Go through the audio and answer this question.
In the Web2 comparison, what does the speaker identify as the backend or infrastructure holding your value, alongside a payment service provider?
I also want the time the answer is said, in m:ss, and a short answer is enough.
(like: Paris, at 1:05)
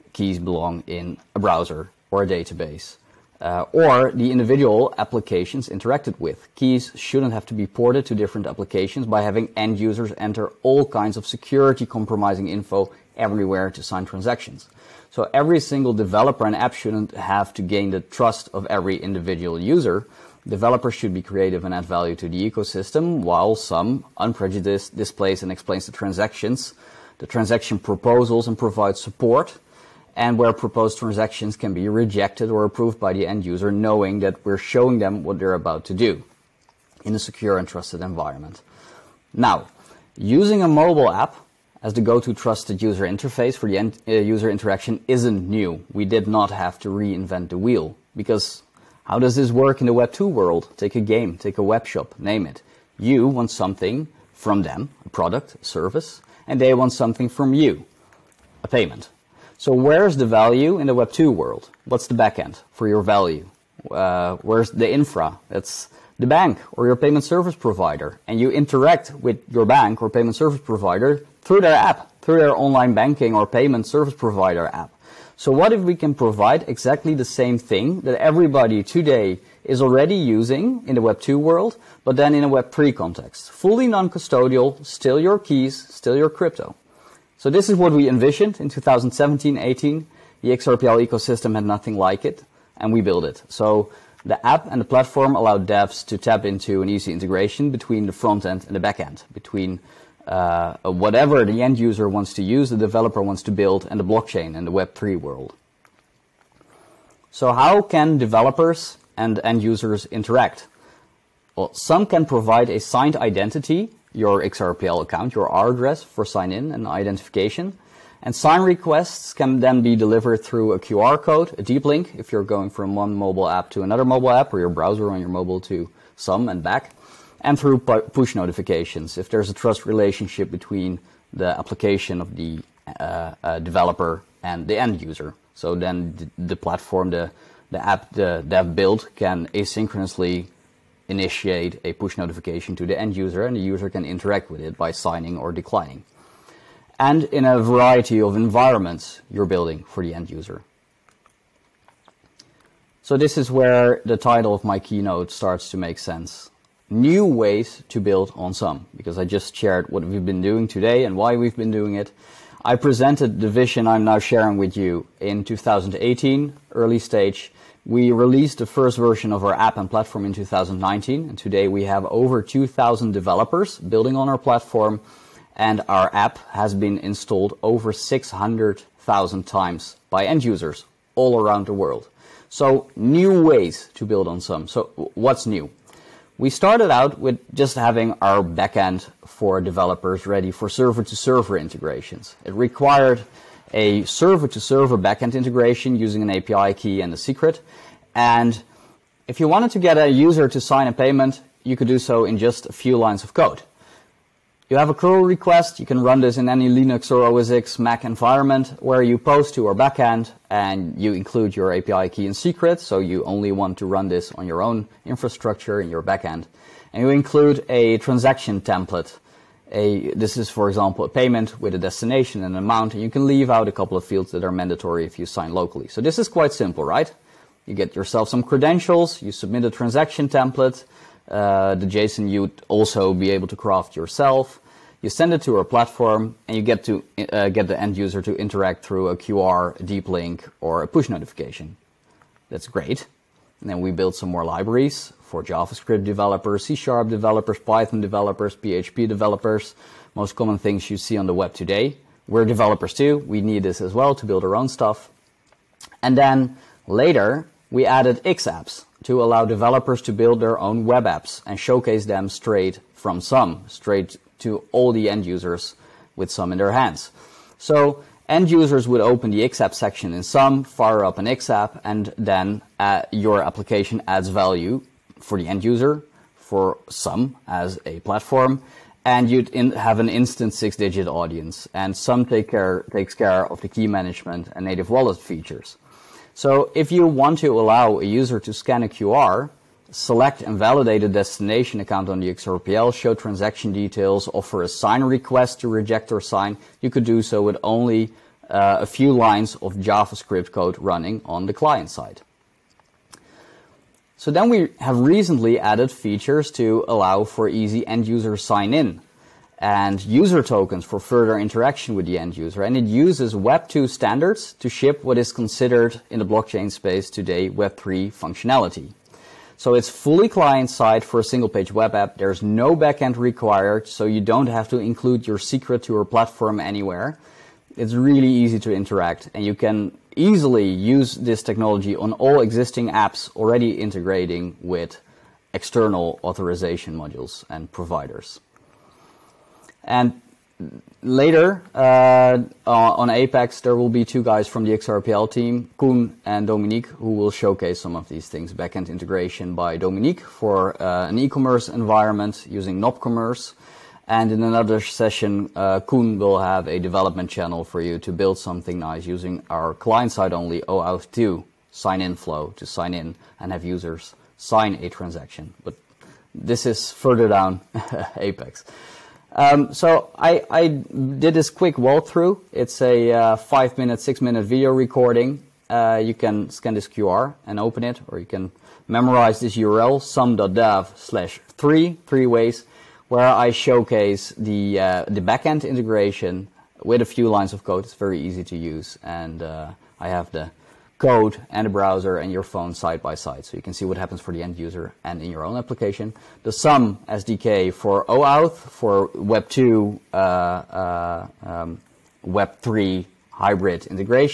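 The bank, at 1:05.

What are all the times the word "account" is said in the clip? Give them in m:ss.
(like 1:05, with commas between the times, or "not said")
1:55, 4:51.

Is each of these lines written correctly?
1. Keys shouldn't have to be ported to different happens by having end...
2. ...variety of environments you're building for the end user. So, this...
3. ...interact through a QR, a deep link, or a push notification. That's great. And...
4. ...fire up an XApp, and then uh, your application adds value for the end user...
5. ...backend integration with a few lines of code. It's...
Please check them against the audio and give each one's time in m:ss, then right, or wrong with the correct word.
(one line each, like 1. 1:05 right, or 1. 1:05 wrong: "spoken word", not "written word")
1. 0:06 wrong: "applications", not "happens"
2. 2:27 right
3. 3:58 right
4. 4:30 right
5. 6:25 right.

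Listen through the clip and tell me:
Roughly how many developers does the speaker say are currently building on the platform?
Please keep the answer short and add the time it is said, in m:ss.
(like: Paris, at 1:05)
Over 2,000, at 2:52.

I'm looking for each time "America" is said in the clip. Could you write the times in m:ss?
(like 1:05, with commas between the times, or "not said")
not said.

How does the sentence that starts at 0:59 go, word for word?
So where's the value in the Web2 world?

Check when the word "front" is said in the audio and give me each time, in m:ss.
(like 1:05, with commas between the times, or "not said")
1:38.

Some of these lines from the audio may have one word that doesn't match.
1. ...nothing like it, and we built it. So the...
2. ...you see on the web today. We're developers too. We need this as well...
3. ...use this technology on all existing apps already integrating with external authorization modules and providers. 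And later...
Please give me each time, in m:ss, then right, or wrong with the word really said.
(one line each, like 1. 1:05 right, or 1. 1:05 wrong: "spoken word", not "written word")
1. 1:31 right
2. 4:10 right
3. 5:30 right.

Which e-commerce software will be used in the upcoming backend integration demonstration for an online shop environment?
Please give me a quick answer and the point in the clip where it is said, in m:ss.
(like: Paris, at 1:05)
NopCommerce, at 5:52.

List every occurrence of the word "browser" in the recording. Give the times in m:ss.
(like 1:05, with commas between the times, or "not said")
0:01, 2:04, 6:31.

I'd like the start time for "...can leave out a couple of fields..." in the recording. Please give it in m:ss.
3:43.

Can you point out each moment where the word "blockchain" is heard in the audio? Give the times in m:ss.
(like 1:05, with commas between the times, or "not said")
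1:44, 5:16.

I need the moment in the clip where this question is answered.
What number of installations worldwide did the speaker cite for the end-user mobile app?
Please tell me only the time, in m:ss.
2:57.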